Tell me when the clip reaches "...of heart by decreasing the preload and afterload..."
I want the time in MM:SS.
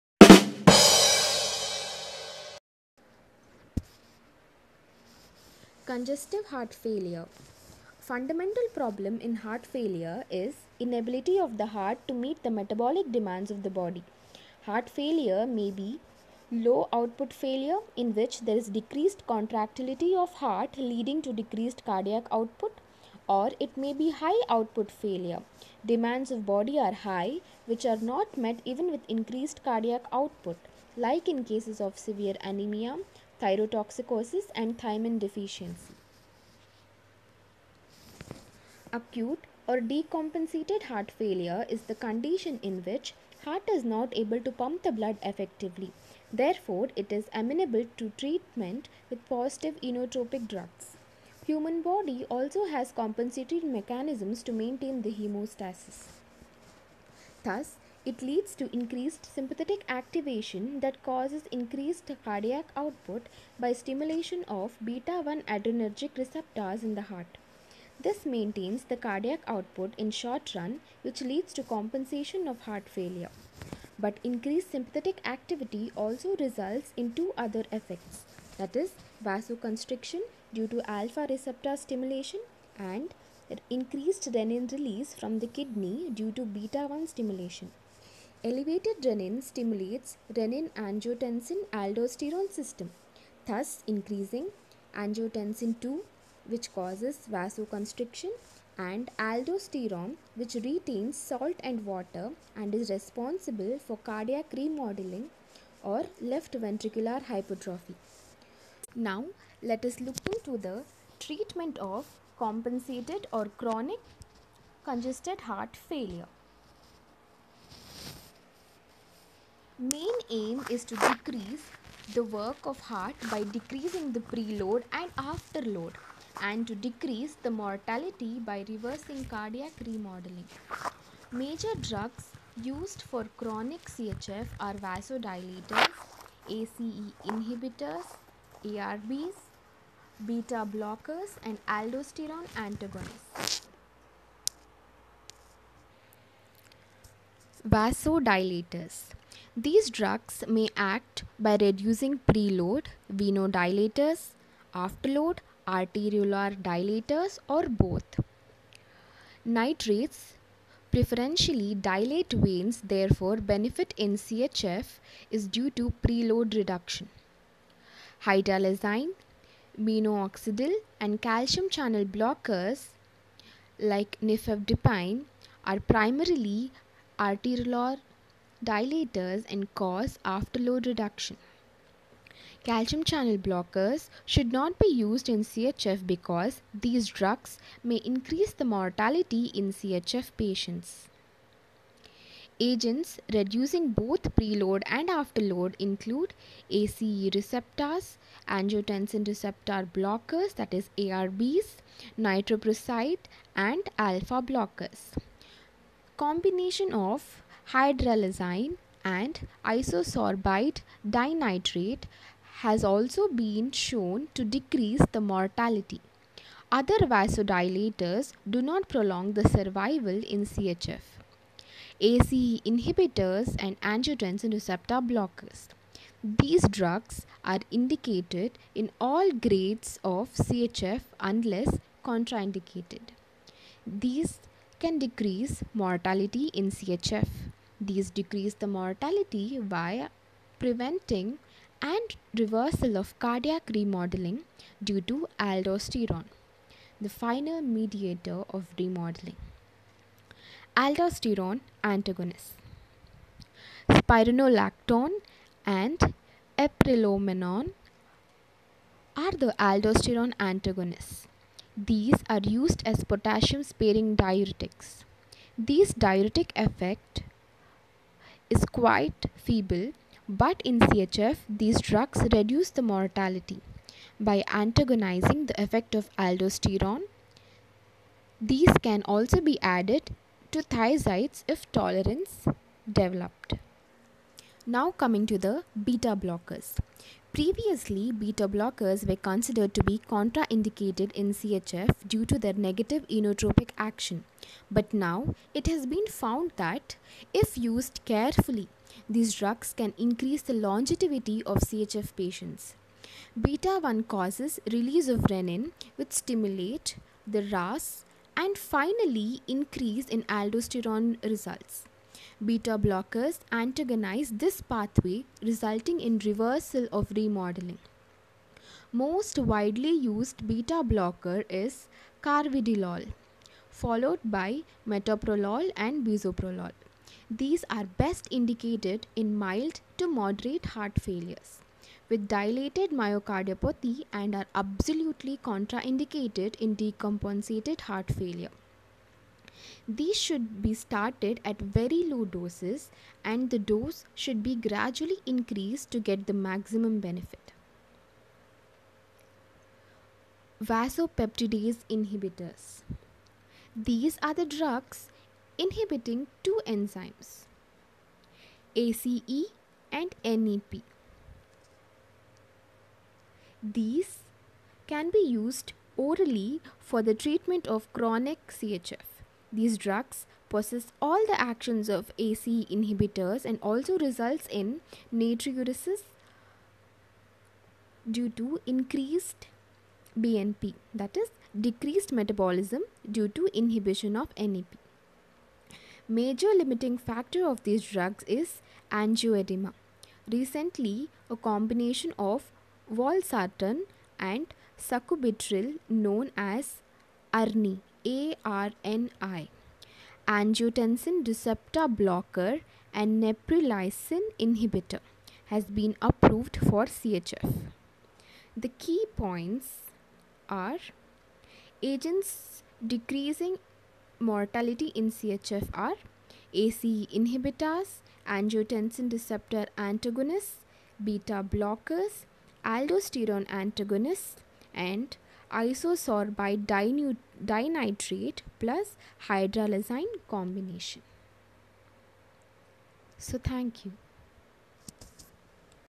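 02:02.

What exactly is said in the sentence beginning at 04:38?
These can also be added to thiazides if tolerance developed.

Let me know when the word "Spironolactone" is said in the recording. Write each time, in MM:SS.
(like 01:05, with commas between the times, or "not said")
04:13.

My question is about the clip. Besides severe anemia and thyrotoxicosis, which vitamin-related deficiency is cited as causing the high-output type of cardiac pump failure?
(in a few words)
Thiamine deficiency.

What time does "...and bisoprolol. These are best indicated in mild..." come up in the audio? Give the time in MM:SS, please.
05:25.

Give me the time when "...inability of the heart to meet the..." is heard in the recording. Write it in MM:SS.
00:10.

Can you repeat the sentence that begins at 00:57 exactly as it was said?
Thus, it leads to increased sympathetic activation that causes increased cardiac output by stimulation of beta 1 adrenergic receptors in the heart.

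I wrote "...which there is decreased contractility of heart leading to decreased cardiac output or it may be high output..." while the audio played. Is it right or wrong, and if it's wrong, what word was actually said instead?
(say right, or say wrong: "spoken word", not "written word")
right.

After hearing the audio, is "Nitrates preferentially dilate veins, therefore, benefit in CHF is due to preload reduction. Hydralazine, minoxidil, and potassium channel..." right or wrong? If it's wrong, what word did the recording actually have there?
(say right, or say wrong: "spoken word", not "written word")
wrong: "calcium", not "potassium".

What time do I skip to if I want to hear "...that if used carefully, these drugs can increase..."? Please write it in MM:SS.
04:56.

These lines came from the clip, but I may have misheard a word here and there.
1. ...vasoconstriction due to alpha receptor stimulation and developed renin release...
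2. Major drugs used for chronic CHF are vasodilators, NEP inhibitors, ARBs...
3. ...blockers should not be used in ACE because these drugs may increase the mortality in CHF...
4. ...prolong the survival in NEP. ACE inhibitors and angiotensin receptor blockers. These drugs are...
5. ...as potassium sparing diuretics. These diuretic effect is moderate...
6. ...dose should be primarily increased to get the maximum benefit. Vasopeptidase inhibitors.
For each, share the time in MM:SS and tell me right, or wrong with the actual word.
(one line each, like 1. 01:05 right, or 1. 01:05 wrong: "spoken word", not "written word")
1. 01:19 wrong: "increased", not "developed"
2. 02:11 wrong: "ACE", not "NEP"
3. 03:03 wrong: "CHF", not "ACE"
4. 03:38 wrong: "CHF", not "NEP"
5. 04:22 wrong: "quite", not "moderate"
6. 05:43 wrong: "gradually", not "primarily".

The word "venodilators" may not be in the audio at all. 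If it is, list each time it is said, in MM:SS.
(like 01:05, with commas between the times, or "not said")
02:33.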